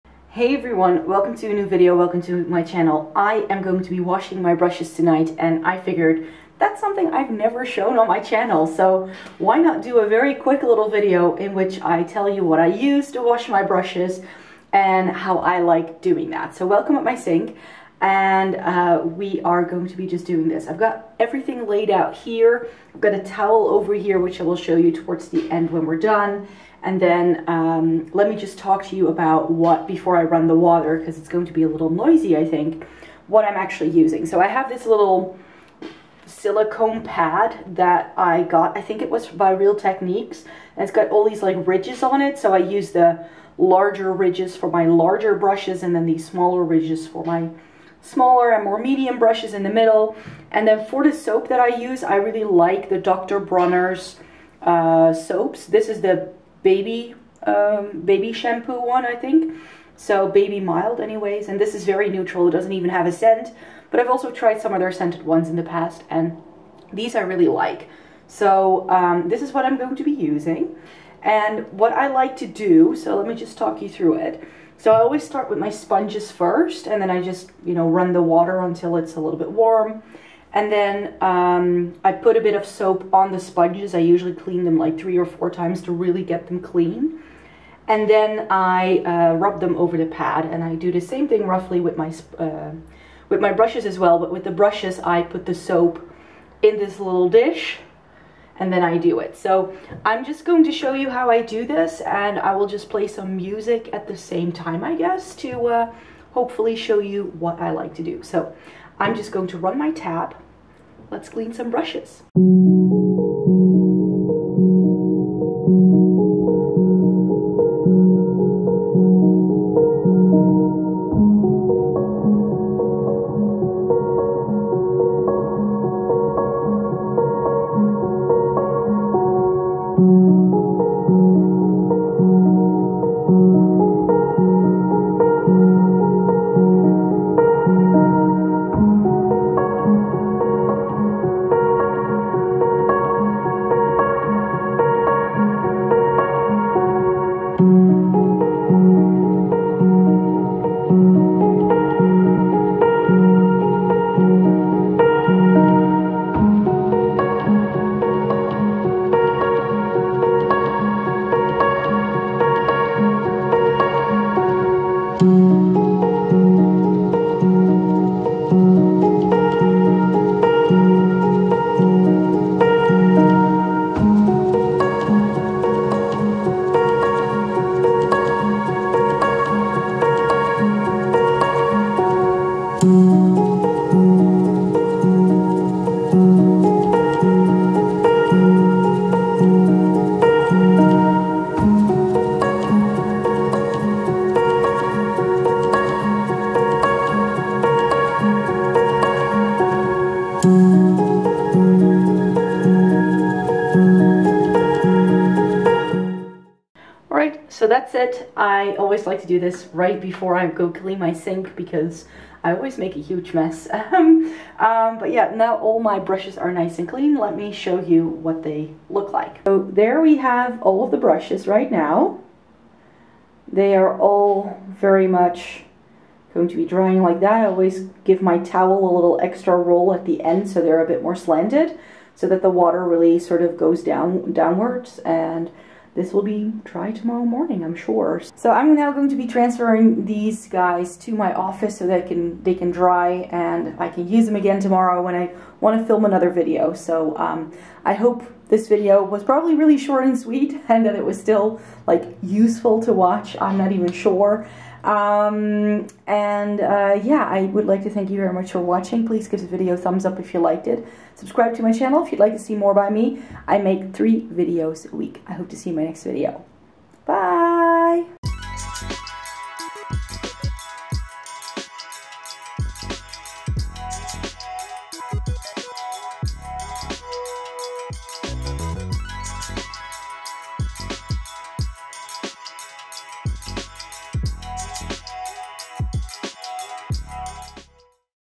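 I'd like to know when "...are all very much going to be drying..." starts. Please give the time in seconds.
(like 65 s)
223 s.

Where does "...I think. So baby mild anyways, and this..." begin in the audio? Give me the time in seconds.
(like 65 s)
59 s.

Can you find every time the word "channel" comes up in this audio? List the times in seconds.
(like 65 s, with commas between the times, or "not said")
2 s, 8 s, 261 s.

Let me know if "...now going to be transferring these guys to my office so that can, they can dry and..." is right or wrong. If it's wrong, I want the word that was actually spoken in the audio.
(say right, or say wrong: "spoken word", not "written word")
right.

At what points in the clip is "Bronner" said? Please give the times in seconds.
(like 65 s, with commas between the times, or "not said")
53 s.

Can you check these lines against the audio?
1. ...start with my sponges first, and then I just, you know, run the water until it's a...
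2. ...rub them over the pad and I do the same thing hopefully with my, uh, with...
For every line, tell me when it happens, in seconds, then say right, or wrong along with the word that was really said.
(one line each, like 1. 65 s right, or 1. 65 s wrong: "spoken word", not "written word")
1. 75 s right
2. 89 s wrong: "roughly", not "hopefully".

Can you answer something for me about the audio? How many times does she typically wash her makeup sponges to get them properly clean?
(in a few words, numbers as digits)
3 or 4 times.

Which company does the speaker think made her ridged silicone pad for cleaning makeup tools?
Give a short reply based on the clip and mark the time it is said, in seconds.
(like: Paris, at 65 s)
Real Techniques, at 39 s.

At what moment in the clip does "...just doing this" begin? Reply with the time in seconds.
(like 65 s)
20 s.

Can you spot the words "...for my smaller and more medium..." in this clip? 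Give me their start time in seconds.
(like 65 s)
47 s.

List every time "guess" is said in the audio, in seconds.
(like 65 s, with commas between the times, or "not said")
104 s.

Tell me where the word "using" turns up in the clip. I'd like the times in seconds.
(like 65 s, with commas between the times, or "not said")
33 s, 70 s.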